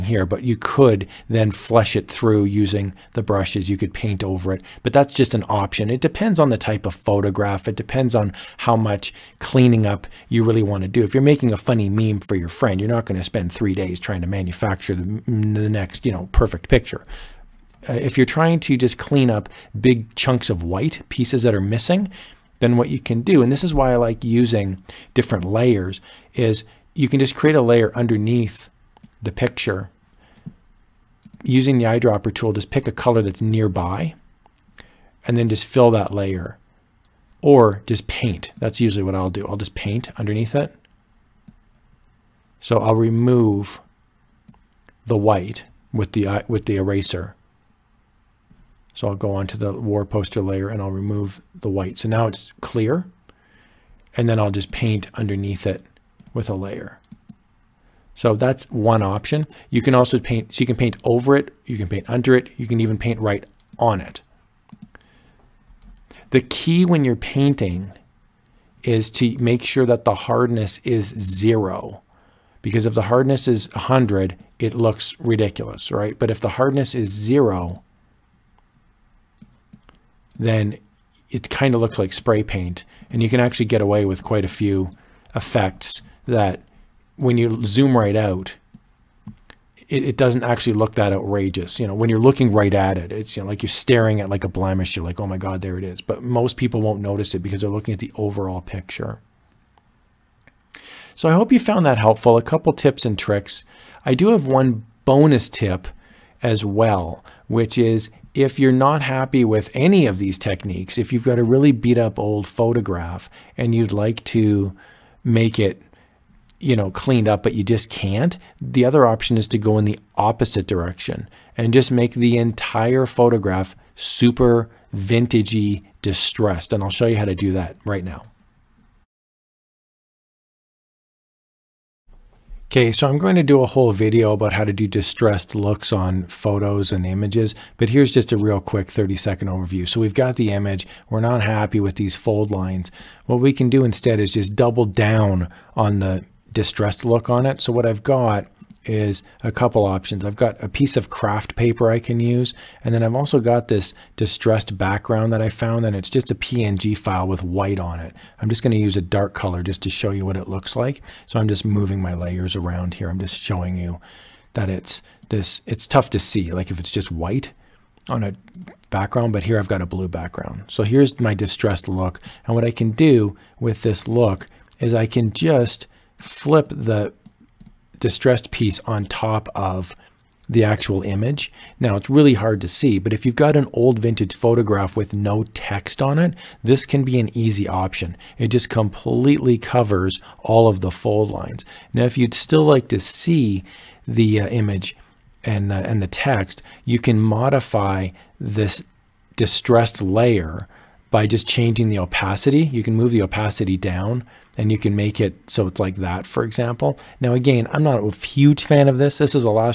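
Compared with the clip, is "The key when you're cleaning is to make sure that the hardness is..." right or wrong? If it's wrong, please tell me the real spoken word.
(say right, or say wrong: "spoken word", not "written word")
wrong: "painting", not "cleaning".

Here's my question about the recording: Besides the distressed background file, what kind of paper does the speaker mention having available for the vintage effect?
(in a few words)
craft paper.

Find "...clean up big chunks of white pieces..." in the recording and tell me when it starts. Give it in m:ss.
0:18.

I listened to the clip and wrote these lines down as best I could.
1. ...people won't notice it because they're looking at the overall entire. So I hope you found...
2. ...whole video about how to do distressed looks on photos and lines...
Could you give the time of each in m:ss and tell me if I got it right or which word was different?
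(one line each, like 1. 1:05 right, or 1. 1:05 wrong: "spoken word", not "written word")
1. 1:36 wrong: "picture", not "entire"
2. 2:13 wrong: "images", not "lines".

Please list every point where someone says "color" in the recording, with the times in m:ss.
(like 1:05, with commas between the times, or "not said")
0:32, 2:39.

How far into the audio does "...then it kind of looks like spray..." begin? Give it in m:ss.
1:20.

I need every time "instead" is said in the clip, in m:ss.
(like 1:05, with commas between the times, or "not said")
2:23.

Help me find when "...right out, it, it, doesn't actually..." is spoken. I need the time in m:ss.
1:27.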